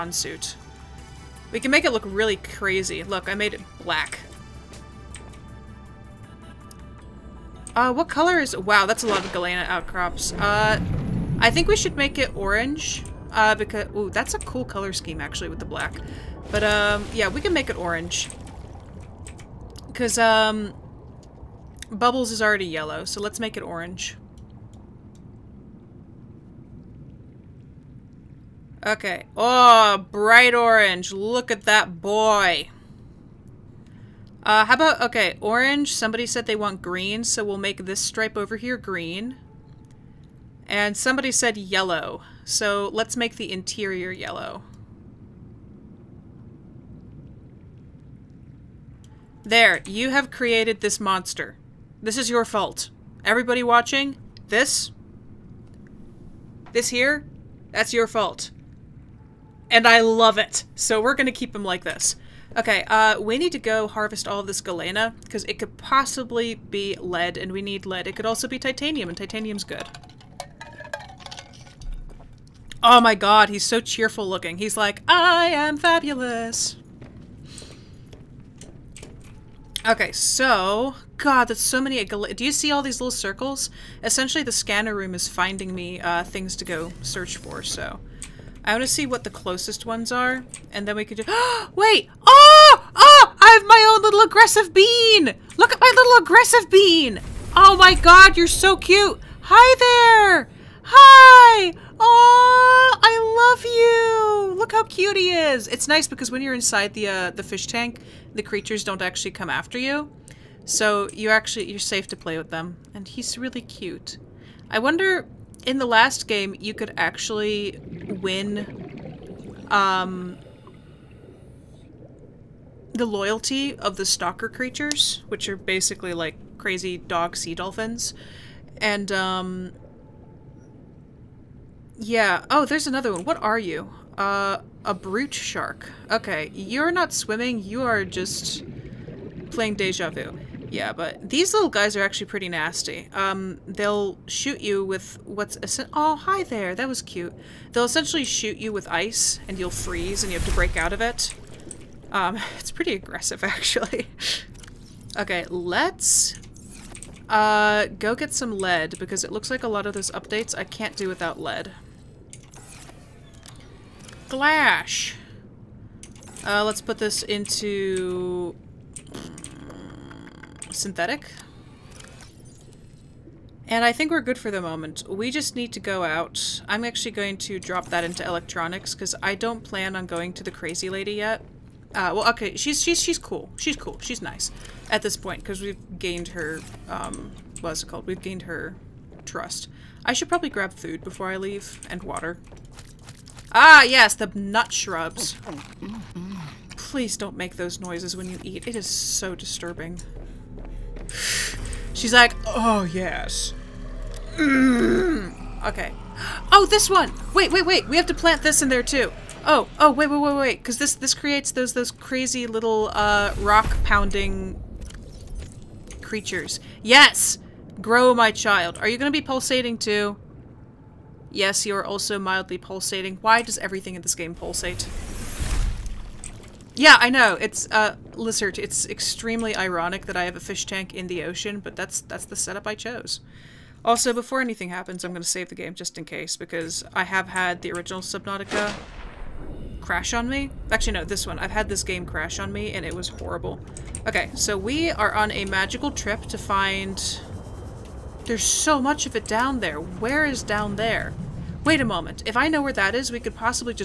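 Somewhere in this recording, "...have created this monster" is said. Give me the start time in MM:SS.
00:50.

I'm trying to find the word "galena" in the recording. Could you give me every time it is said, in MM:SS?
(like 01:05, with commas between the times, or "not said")
00:09, 01:04.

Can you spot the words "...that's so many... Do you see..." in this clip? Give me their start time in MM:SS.
01:21.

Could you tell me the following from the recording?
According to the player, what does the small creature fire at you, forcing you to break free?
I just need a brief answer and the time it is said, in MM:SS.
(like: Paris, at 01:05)
Ice, at 02:28.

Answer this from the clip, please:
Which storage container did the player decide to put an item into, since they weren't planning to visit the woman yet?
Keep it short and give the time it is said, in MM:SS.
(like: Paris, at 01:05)
Electronics, at 02:58.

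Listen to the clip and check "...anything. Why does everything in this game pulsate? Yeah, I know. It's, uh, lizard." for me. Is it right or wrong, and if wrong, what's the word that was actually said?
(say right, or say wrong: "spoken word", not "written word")
wrong: "pulsating", not "anything".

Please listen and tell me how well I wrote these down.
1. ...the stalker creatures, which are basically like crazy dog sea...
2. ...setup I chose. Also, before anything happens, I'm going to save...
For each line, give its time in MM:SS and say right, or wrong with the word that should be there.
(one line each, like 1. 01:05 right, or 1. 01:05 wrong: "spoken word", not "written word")
1. 02:03 right
2. 03:52 right.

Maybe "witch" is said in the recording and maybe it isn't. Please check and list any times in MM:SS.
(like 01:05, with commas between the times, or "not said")
not said.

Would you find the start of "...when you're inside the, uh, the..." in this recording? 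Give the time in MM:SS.
01:46.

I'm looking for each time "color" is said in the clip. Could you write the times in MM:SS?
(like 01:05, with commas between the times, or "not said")
00:08, 00:14.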